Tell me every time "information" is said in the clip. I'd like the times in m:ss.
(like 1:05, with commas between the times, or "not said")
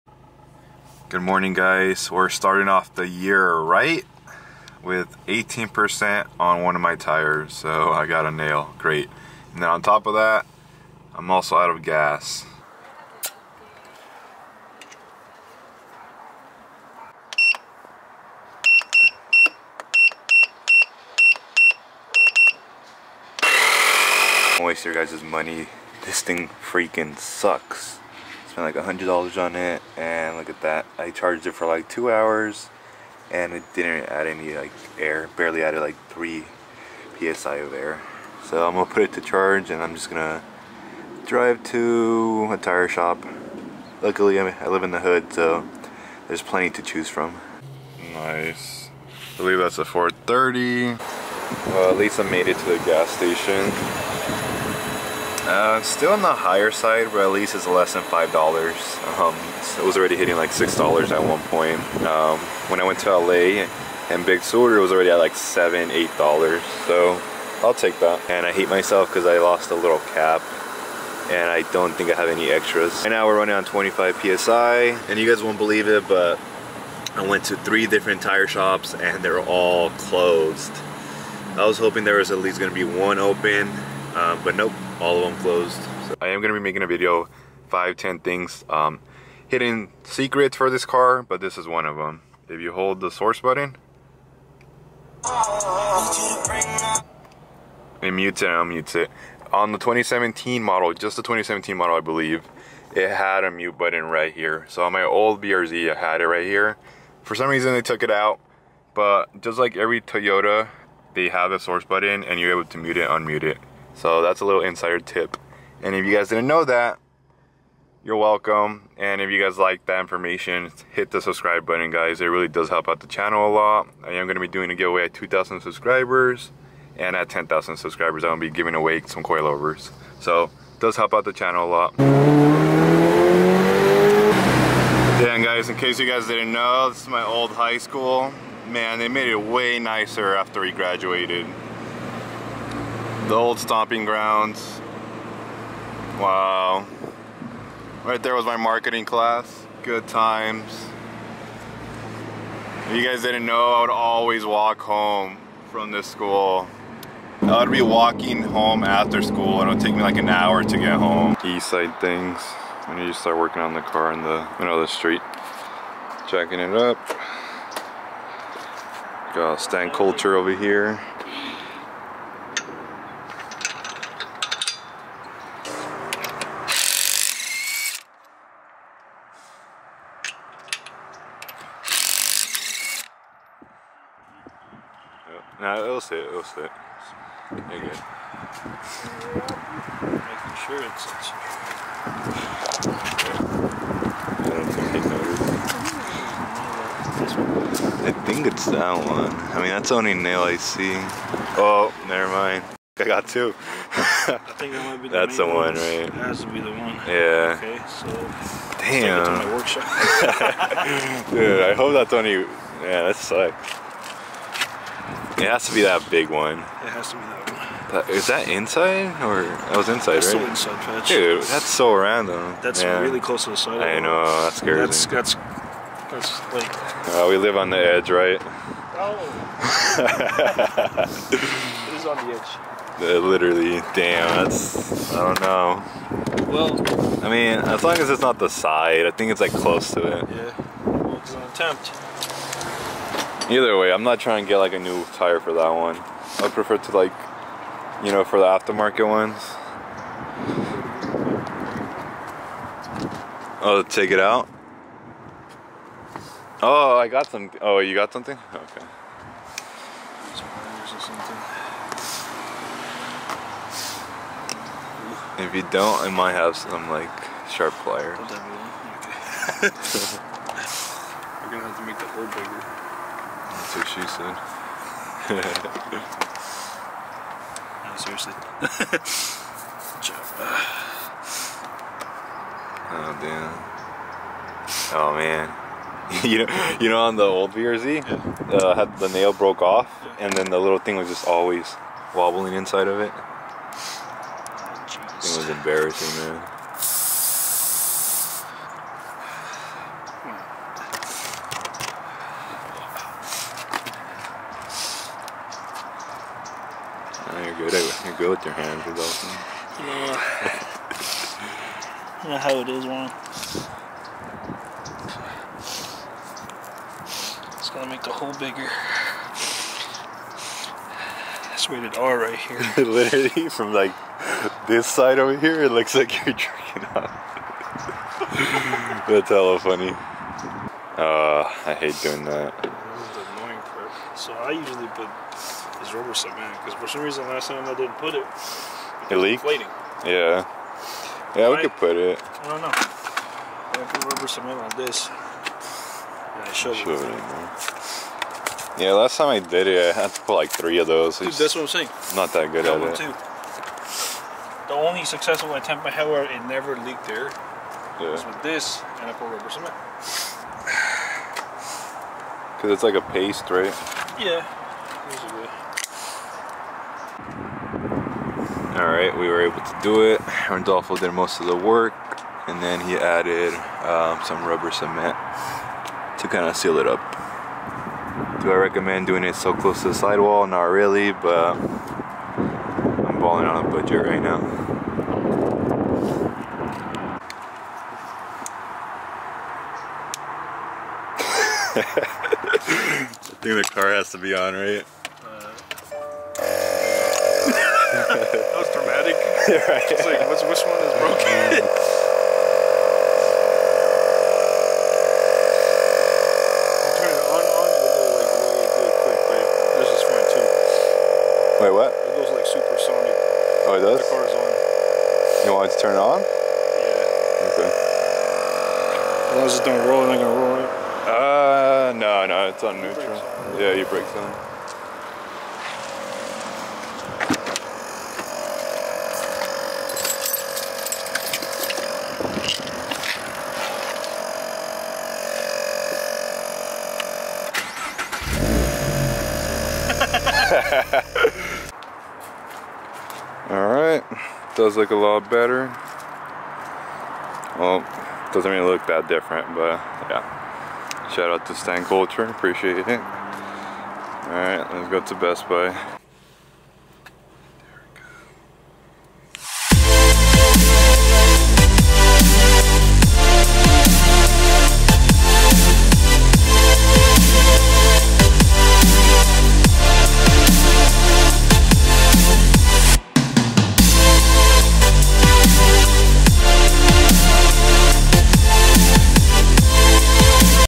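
2:00.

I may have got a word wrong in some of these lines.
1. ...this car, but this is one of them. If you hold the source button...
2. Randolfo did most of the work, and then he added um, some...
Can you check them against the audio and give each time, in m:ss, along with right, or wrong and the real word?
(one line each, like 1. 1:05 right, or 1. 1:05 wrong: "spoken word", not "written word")
1. 1:30 right
2. 6:10 right.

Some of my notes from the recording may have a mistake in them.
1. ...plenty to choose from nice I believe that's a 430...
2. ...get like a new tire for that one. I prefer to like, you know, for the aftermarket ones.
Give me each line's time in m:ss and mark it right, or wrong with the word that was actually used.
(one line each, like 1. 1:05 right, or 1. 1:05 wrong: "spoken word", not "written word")
1. 0:46 right
2. 4:04 right.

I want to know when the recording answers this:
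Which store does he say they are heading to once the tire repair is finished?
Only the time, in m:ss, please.
7:35.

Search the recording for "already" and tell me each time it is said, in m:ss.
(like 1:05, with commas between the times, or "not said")
0:59, 1:04.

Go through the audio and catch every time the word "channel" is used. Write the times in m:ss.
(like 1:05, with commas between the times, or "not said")
2:03, 2:11.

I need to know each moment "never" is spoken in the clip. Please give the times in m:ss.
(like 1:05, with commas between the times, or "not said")
3:22, 5:56.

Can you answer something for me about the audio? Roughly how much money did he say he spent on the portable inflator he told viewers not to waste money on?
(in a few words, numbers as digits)
$100.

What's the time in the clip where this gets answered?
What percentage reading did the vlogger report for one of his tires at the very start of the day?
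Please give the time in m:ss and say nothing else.
0:05.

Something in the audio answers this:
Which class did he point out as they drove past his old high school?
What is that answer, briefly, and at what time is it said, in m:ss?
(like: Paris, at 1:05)
Marketing class, at 2:28.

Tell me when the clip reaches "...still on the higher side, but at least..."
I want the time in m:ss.
0:55.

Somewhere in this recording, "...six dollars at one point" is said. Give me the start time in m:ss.
1:00.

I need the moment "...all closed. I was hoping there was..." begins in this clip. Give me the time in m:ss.
1:19.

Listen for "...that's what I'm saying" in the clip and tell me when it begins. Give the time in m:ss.
5:51.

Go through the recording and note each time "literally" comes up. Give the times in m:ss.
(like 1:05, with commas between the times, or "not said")
3:53, 5:22.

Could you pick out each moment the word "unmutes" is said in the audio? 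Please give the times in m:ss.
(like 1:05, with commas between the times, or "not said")
1:38, 1:53.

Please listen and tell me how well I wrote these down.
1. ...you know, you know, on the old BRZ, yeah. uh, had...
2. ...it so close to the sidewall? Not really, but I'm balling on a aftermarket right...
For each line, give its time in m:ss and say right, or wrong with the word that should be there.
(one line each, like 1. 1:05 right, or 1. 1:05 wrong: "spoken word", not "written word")
1. 4:46 right
2. 6:19 wrong: "budget", not "aftermarket".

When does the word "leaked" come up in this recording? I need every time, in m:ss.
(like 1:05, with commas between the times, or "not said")
5:39, 5:56.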